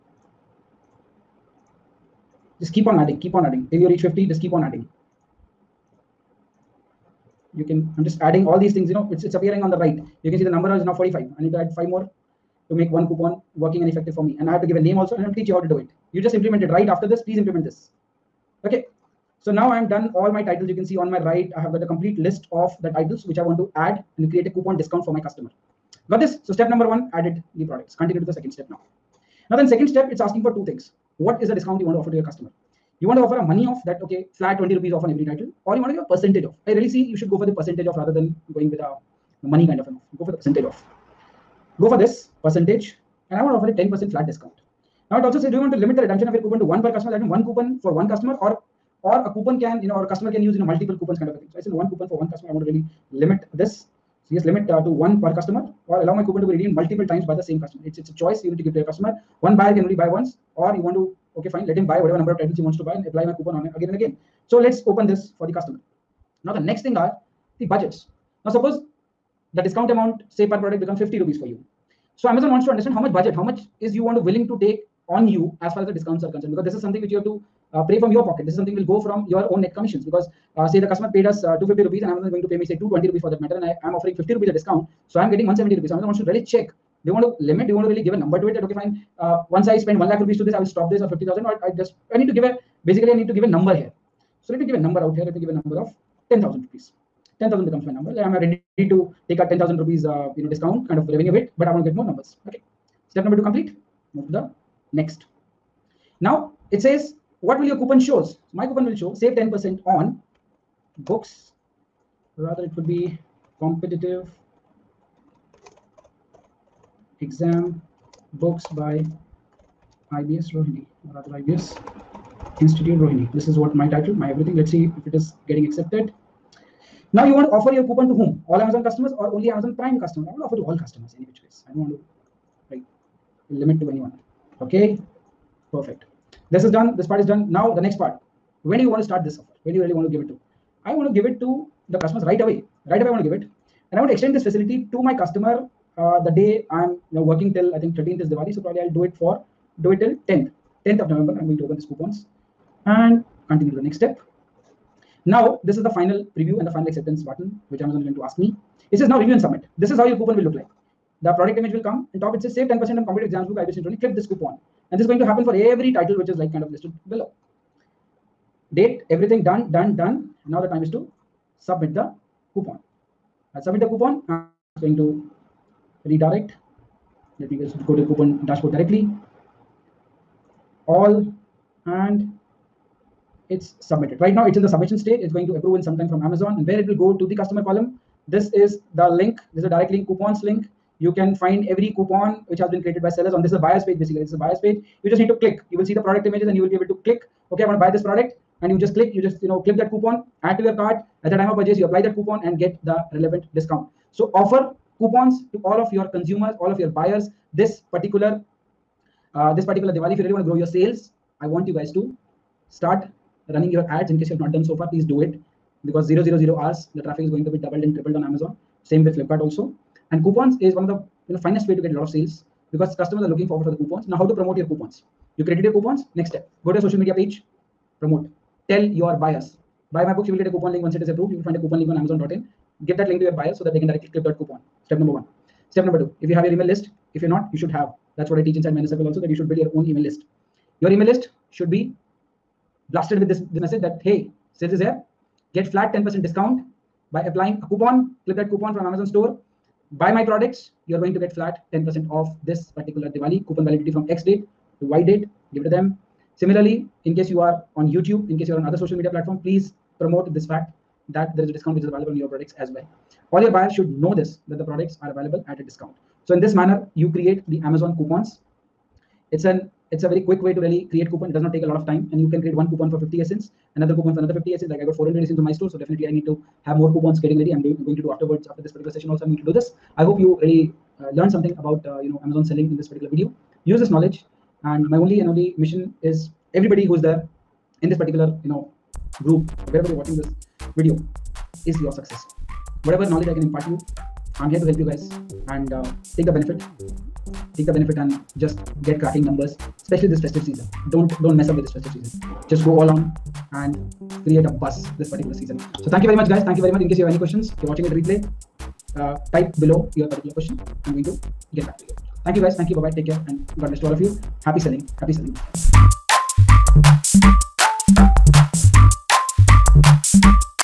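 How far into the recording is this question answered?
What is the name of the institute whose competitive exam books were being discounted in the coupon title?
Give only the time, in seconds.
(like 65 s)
121 s.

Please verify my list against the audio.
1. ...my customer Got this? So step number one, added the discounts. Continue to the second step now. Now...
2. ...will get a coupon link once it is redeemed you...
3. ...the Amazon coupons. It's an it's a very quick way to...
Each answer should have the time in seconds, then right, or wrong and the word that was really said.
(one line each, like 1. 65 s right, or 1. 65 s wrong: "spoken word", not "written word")
1. 25 s wrong: "products", not "discounts"
2. 230 s wrong: "approved", not "redeemed"
3. 267 s right.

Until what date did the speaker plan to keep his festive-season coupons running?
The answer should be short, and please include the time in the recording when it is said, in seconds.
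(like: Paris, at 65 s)
10th November, at 150 s.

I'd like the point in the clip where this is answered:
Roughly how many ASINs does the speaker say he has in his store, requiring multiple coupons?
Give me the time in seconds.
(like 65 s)
274 s.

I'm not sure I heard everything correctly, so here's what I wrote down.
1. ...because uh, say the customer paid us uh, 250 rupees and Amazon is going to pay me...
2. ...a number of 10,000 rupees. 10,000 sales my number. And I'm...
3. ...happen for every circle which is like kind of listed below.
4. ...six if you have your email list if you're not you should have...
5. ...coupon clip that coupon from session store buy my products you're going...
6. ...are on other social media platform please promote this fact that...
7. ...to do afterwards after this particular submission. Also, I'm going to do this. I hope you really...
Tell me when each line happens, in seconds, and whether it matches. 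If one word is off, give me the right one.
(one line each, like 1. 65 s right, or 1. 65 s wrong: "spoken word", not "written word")
1. 80 s right
2. 95 s wrong: "becomes", not "sales"
3. 165 s wrong: "title", not "circle"
4. 236 s wrong: "two", not "six"
5. 247 s wrong: "amazon", not "session"
6. 258 s right
7. 277 s wrong: "session", not "submission".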